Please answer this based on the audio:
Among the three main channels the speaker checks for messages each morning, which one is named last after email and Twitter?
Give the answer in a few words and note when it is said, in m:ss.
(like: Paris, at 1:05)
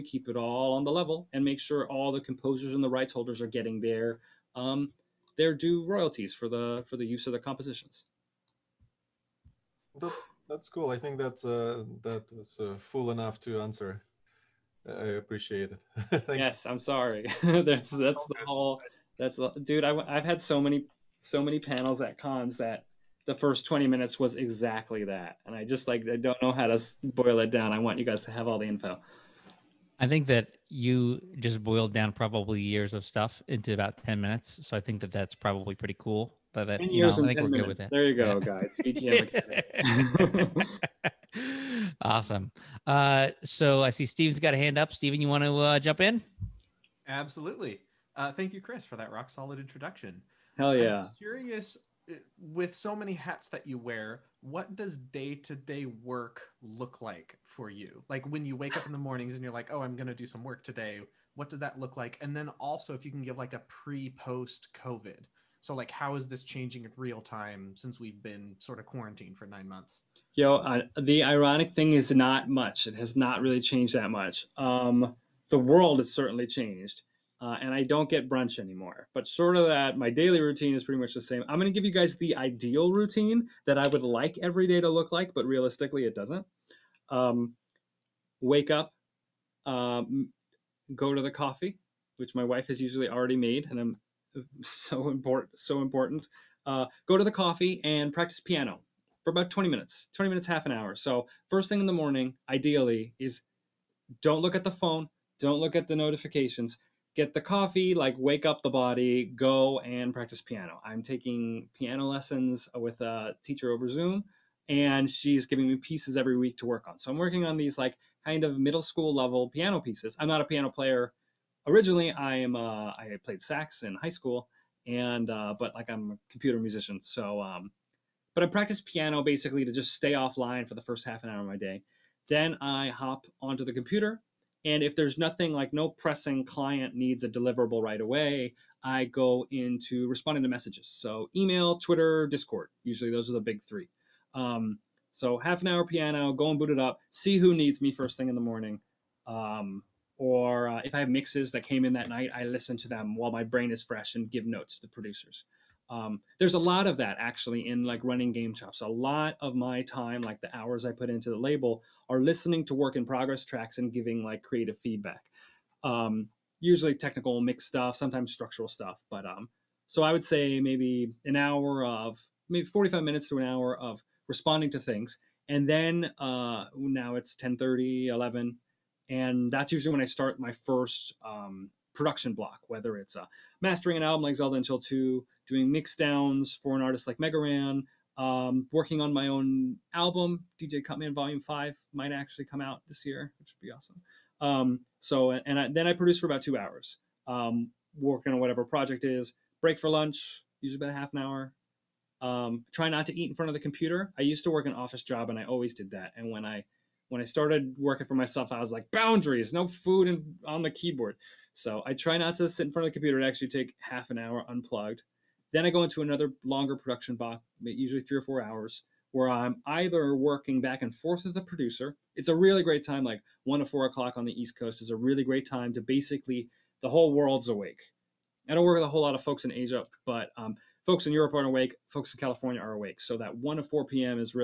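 Discord, at 2:22.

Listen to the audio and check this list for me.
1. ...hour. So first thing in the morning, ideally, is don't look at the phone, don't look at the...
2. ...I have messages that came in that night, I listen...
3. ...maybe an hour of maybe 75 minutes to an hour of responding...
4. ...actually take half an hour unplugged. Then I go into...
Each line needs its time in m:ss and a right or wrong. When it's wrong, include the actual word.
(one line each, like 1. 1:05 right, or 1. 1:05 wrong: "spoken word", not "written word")
1. 1:40 right
2. 2:30 wrong: "mixes", not "messages"
3. 2:50 wrong: "45", not "75"
4. 3:33 right.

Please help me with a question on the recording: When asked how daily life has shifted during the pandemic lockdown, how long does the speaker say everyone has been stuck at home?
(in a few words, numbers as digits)
9 months.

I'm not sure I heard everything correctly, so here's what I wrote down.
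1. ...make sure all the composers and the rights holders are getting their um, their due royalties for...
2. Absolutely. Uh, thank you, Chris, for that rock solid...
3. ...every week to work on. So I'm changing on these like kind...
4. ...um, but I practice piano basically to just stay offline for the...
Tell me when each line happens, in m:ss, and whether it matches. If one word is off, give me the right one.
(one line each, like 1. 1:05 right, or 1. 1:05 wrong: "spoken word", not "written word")
1. 0:01 right
2. 0:47 right
3. 1:56 wrong: "working", not "changing"
4. 2:07 right.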